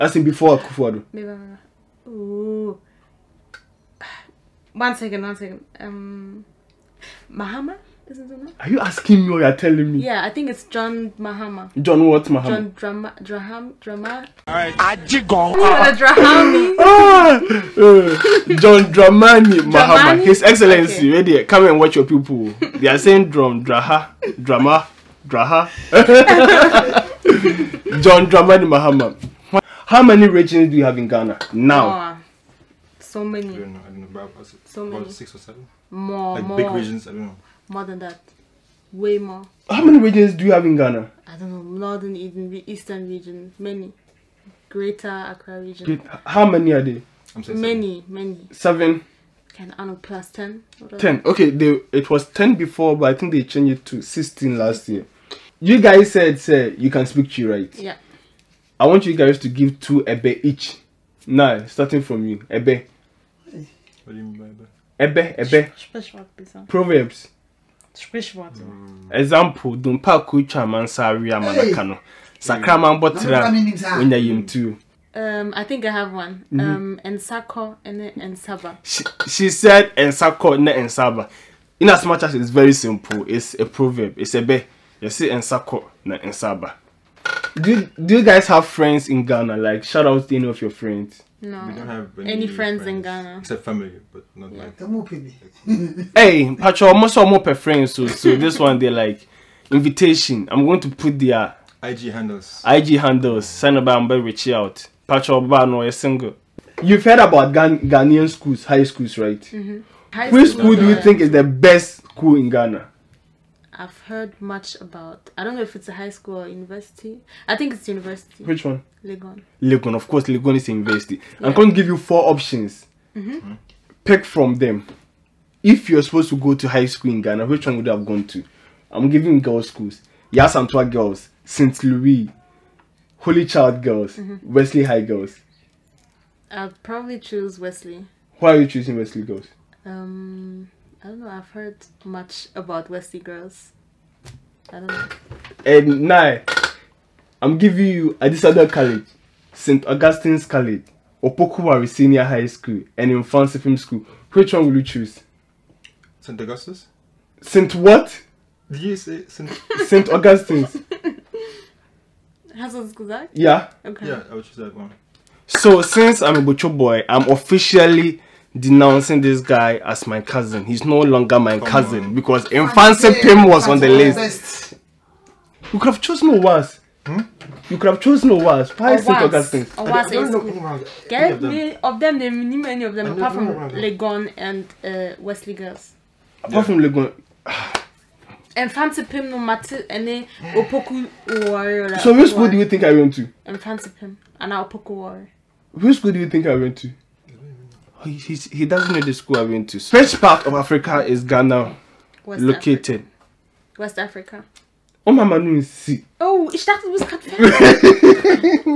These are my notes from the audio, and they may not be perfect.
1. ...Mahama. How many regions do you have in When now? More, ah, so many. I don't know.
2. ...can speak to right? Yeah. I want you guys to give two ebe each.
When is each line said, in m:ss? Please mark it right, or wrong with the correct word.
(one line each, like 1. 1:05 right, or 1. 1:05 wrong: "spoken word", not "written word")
1. 0:28 wrong: "Ghana", not "When"
2. 0:56 right.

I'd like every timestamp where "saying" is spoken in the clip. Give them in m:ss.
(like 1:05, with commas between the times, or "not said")
0:22.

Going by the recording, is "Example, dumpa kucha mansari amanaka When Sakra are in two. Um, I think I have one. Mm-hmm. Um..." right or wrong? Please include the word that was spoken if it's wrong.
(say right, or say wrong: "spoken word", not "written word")
right.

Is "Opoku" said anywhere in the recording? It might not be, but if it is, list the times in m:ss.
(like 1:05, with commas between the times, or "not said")
2:31, 3:10, 3:14.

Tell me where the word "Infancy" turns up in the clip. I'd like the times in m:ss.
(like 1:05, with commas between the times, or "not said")
2:33, 2:52, 3:08, 3:13.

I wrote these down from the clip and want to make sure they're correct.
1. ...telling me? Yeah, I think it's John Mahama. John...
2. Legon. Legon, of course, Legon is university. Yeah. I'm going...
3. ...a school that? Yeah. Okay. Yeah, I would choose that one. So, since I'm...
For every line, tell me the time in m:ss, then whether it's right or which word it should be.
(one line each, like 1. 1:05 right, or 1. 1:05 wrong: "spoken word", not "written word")
1. 0:09 right
2. 1:59 right
3. 2:42 right.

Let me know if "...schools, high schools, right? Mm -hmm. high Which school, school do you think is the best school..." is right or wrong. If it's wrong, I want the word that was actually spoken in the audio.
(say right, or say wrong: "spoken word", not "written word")
right.